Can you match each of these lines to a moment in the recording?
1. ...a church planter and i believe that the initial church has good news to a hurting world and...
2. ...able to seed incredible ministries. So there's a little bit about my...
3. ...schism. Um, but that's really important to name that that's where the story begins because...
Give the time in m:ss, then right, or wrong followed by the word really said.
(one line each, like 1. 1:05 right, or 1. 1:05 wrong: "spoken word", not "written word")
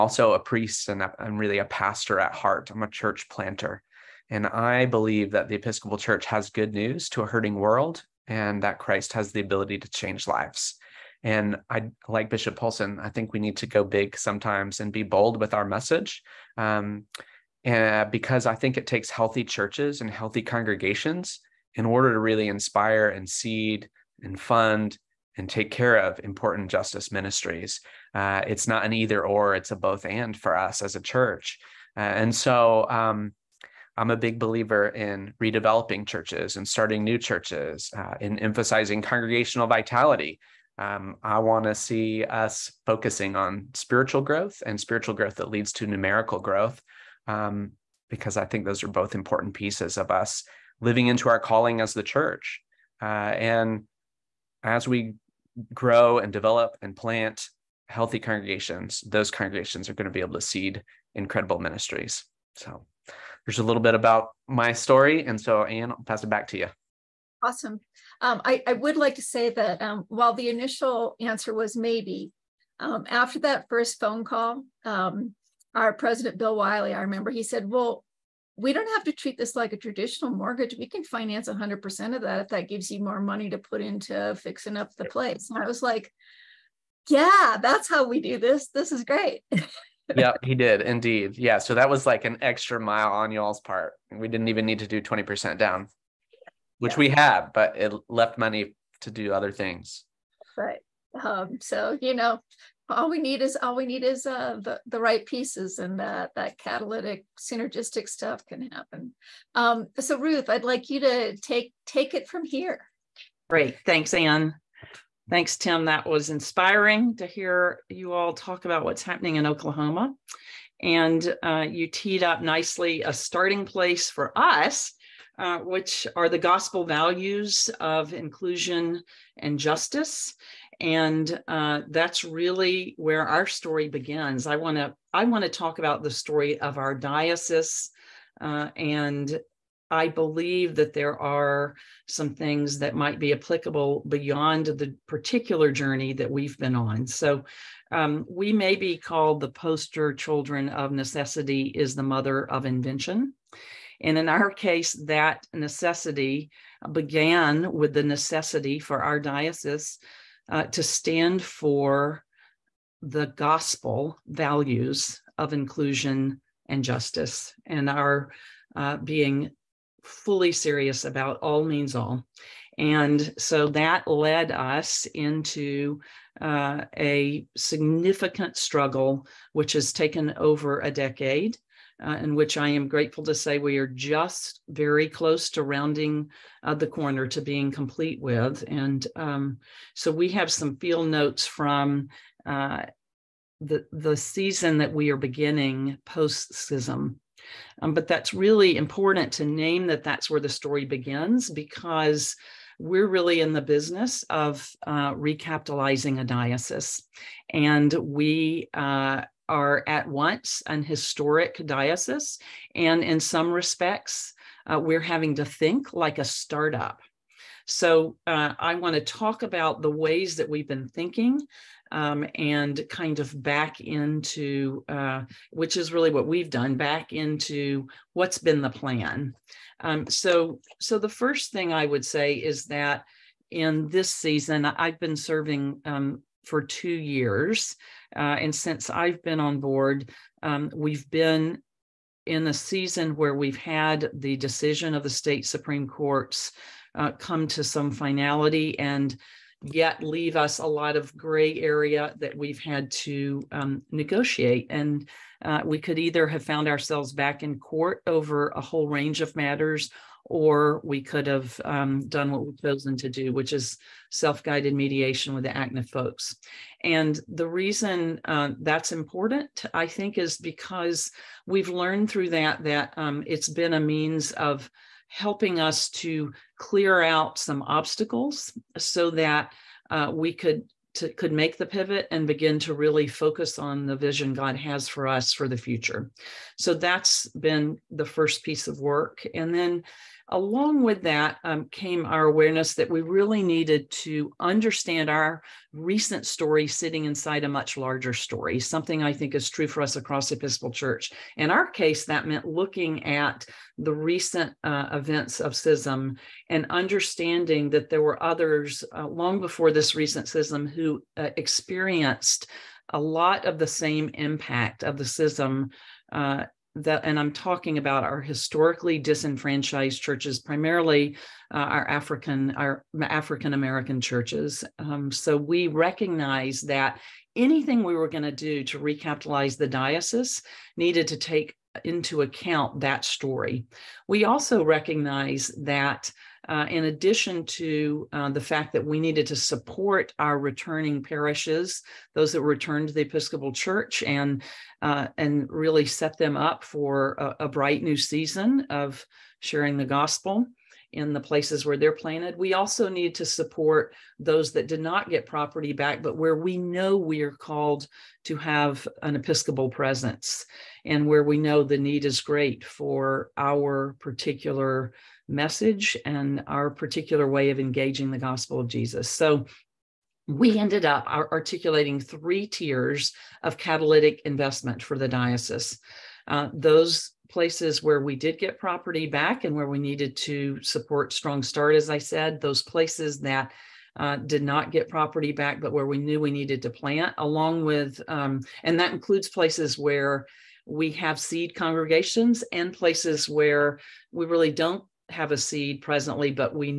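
1. 0:02 wrong: "episcopal", not "initial"
2. 1:00 right
3. 3:16 right.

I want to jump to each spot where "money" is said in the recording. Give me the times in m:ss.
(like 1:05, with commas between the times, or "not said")
1:23, 1:38.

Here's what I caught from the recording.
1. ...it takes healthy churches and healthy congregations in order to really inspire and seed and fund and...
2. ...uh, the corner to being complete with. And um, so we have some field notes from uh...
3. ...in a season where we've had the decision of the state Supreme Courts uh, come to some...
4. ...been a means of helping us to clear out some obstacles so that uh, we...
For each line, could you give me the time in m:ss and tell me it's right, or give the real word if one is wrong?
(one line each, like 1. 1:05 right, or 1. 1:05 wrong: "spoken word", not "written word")
1. 0:18 right
2. 3:06 right
3. 4:02 right
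4. 4:33 right.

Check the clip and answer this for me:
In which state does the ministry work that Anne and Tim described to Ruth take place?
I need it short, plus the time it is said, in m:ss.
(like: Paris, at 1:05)
Oklahoma, at 1:59.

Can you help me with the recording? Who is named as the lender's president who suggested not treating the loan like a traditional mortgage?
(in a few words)
Bill Wiley.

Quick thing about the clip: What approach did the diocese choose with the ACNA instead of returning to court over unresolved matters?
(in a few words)
self-guided mediation.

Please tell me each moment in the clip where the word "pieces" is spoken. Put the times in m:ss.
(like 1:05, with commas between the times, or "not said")
0:49, 1:45, 4:48.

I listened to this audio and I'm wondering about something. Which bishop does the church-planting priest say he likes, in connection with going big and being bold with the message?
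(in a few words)
Bishop Poulson.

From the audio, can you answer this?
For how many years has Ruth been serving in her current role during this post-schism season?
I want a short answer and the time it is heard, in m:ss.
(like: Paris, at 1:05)
2, at 3:56.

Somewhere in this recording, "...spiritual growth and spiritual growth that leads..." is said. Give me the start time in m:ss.
0:43.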